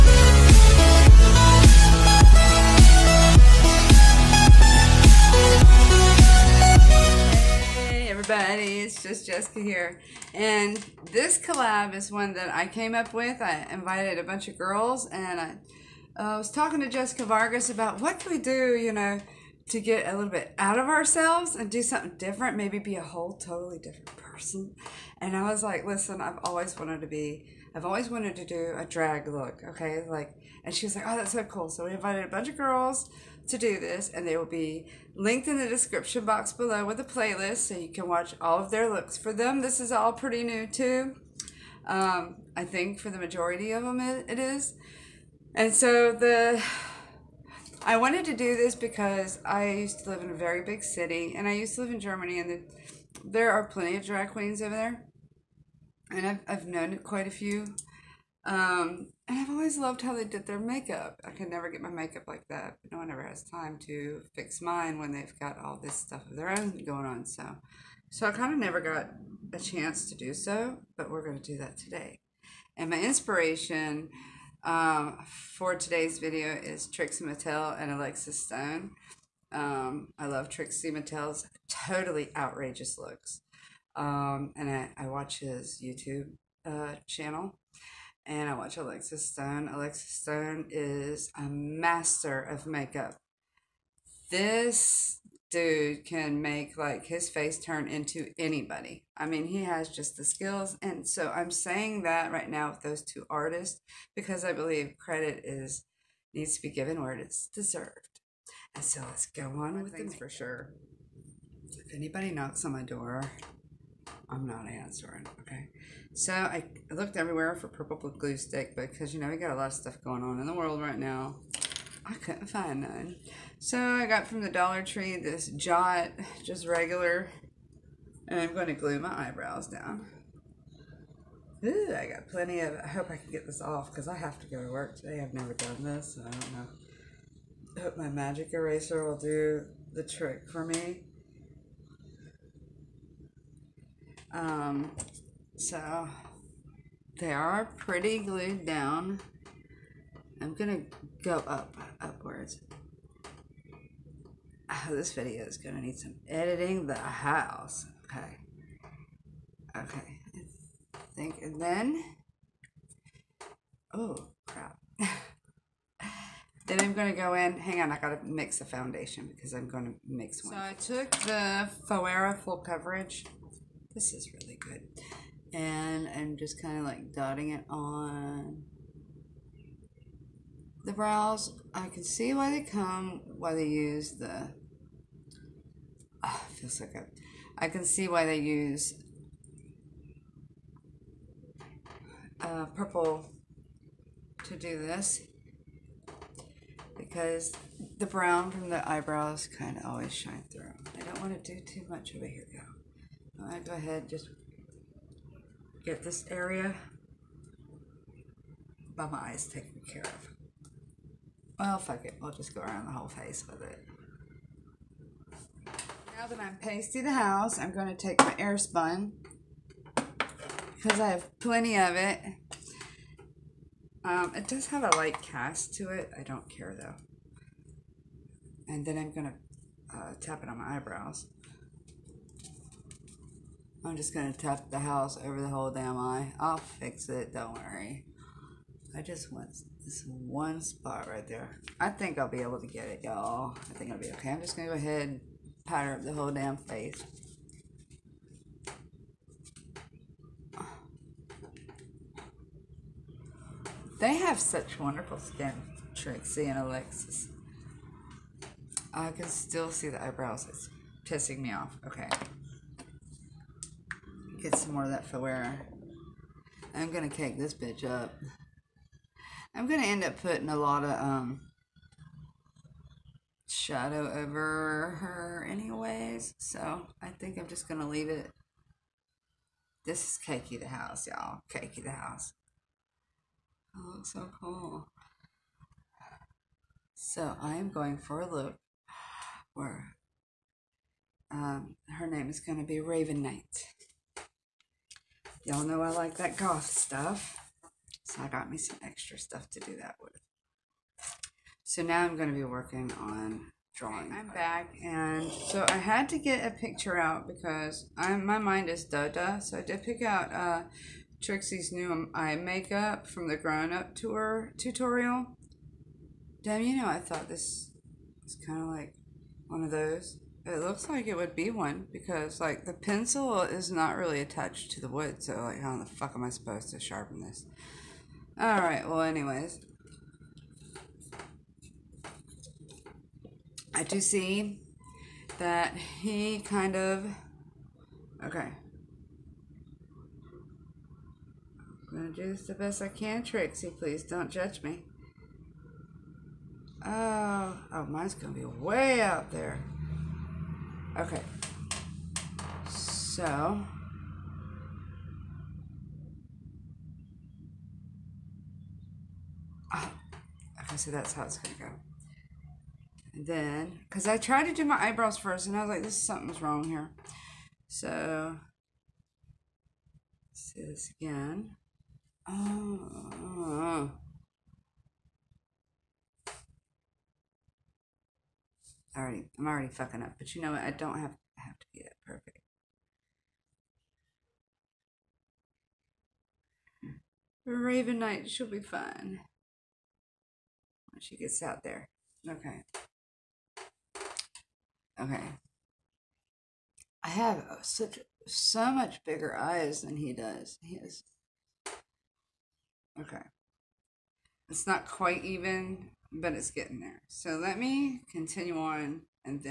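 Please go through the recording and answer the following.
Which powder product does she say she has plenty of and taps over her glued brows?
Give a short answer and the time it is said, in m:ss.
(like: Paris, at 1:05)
Airspun, at 3:38.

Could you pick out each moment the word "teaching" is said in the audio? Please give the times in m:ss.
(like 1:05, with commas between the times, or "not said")
not said.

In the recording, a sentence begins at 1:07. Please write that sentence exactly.
So, so I kind of never got a chance to do so, but we're going to do that today.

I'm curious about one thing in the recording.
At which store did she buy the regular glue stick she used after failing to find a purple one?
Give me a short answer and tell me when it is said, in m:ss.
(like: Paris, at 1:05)
Dollar Tree, at 2:04.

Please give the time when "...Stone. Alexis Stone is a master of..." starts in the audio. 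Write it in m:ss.
1:29.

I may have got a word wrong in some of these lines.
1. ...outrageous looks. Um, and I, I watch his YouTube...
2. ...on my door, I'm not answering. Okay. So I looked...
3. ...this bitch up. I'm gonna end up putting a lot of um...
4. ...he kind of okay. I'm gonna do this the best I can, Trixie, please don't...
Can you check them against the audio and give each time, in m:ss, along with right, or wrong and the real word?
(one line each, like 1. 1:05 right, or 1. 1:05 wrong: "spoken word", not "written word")
1. 1:22 right
2. 1:52 right
3. 4:27 right
4. 5:35 right.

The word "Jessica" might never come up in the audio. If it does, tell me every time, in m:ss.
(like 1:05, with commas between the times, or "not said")
0:09, 0:16.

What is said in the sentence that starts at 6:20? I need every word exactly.
I don't have, have to be that perfect.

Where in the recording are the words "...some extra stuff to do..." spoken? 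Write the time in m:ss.
4:58.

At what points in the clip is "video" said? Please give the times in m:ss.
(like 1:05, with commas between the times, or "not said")
1:16, 2:35.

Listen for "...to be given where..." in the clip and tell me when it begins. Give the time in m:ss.
1:46.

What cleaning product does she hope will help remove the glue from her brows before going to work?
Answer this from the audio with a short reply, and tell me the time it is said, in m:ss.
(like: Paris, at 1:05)
magic eraser, at 2:18.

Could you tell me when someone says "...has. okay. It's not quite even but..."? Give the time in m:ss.
6:40.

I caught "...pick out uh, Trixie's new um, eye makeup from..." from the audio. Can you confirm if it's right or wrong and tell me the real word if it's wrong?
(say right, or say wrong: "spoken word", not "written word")
right.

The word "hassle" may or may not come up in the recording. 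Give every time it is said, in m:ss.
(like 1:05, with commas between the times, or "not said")
not said.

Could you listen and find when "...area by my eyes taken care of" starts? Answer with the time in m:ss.
3:26.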